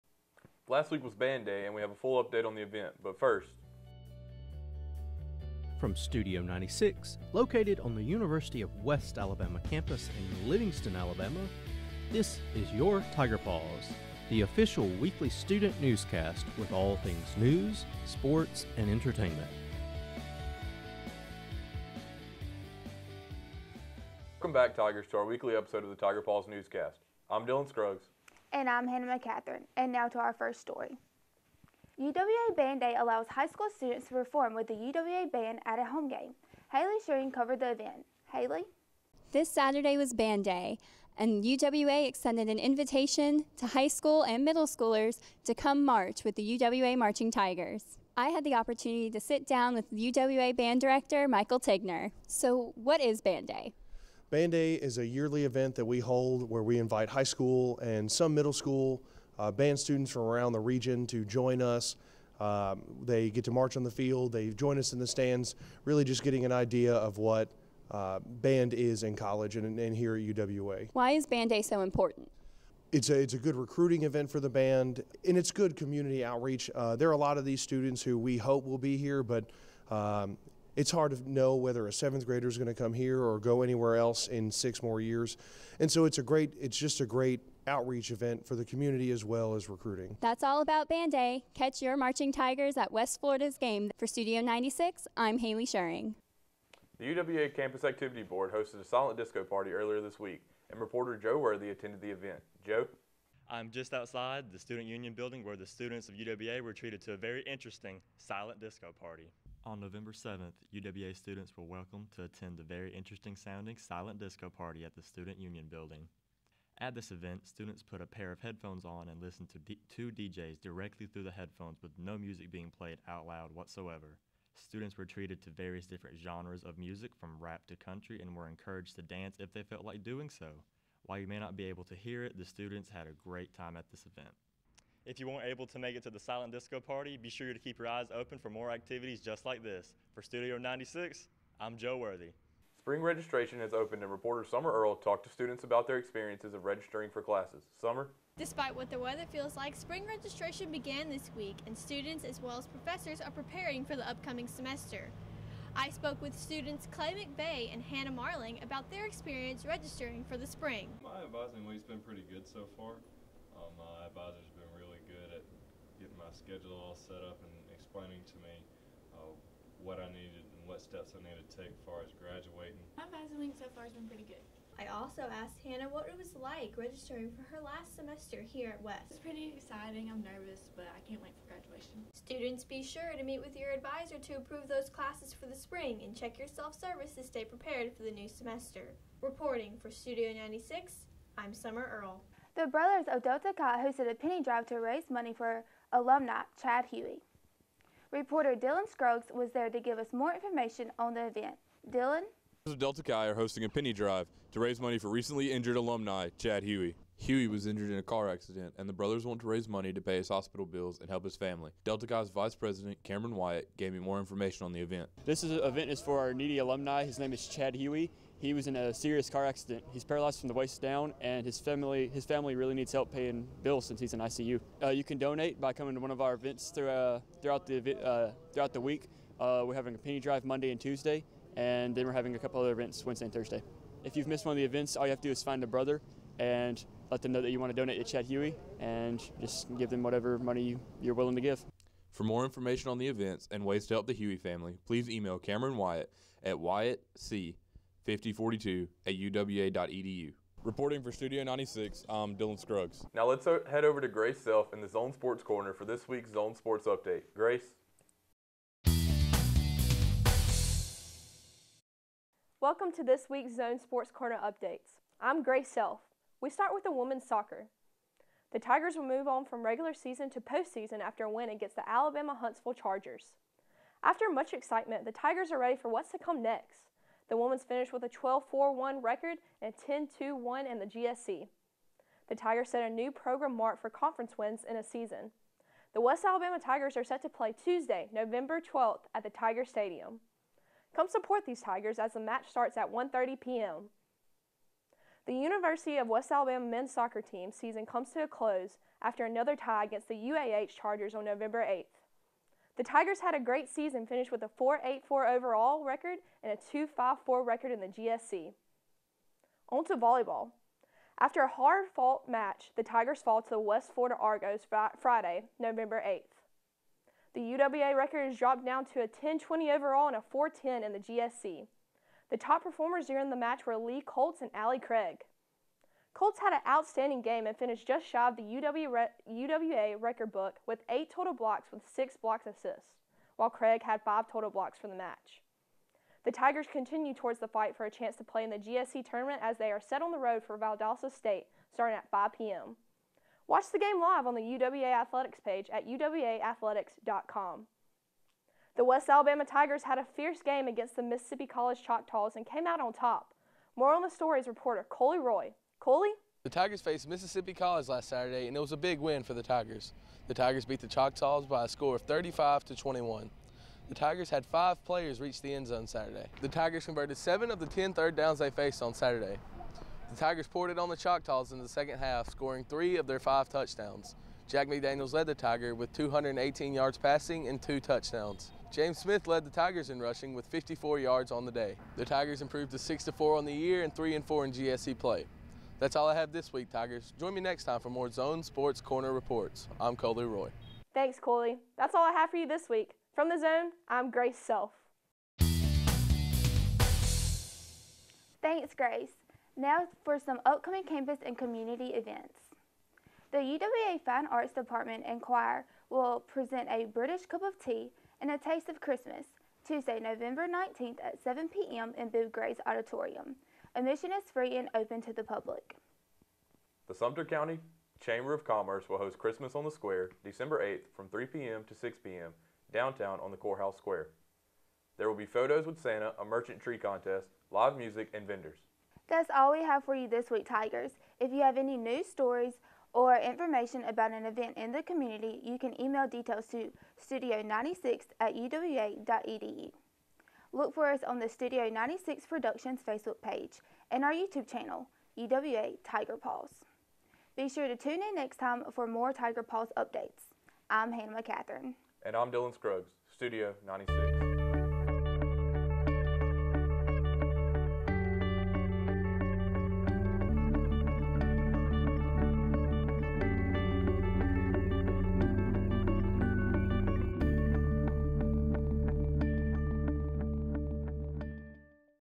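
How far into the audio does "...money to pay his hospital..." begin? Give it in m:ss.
3:29.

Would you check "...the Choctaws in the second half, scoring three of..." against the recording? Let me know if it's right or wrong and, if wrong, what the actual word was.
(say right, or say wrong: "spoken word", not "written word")
right.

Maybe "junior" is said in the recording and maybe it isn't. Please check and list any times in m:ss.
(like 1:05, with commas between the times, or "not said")
not said.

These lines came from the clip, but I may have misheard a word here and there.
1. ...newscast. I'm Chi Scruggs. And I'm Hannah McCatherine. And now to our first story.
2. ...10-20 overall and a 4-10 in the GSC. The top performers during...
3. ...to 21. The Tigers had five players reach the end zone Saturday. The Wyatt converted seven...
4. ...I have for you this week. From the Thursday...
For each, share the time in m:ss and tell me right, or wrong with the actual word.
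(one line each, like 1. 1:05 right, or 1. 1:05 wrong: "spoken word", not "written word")
1. 0:26 wrong: "Dylan", not "Chi"
2. 5:19 right
3. 6:02 wrong: "Tigers", not "Wyatt"
4. 6:32 wrong: "Zone", not "Thursday".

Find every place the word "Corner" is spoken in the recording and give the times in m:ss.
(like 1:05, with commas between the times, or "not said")
4:15, 4:24, 6:28.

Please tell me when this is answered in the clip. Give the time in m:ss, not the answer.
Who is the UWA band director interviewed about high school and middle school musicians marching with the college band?
0:51.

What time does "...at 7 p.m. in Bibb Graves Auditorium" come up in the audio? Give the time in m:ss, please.
6:51.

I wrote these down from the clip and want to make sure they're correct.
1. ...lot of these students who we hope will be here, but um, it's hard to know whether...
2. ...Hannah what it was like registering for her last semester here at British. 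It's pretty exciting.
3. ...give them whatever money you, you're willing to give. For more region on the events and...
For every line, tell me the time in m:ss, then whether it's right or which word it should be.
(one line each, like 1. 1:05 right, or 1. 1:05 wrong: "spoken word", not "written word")
1. 1:17 right
2. 2:55 wrong: "West", not "British"
3. 3:59 wrong: "information", not "region".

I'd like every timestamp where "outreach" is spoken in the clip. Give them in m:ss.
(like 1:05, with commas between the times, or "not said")
1:16, 1:27.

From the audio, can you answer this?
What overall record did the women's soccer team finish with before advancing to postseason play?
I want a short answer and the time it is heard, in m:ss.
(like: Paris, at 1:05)
12-4-1, at 4:38.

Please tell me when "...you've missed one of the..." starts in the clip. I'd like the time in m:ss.
3:54.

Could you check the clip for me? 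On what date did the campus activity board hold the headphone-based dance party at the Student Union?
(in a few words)
November 7.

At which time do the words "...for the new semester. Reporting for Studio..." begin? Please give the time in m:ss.
3:07.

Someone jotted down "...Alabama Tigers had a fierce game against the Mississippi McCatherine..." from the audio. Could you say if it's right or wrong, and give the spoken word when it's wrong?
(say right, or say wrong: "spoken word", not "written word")
wrong: "College", not "McCatherine".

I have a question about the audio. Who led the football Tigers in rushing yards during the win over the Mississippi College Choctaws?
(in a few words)
James Smith.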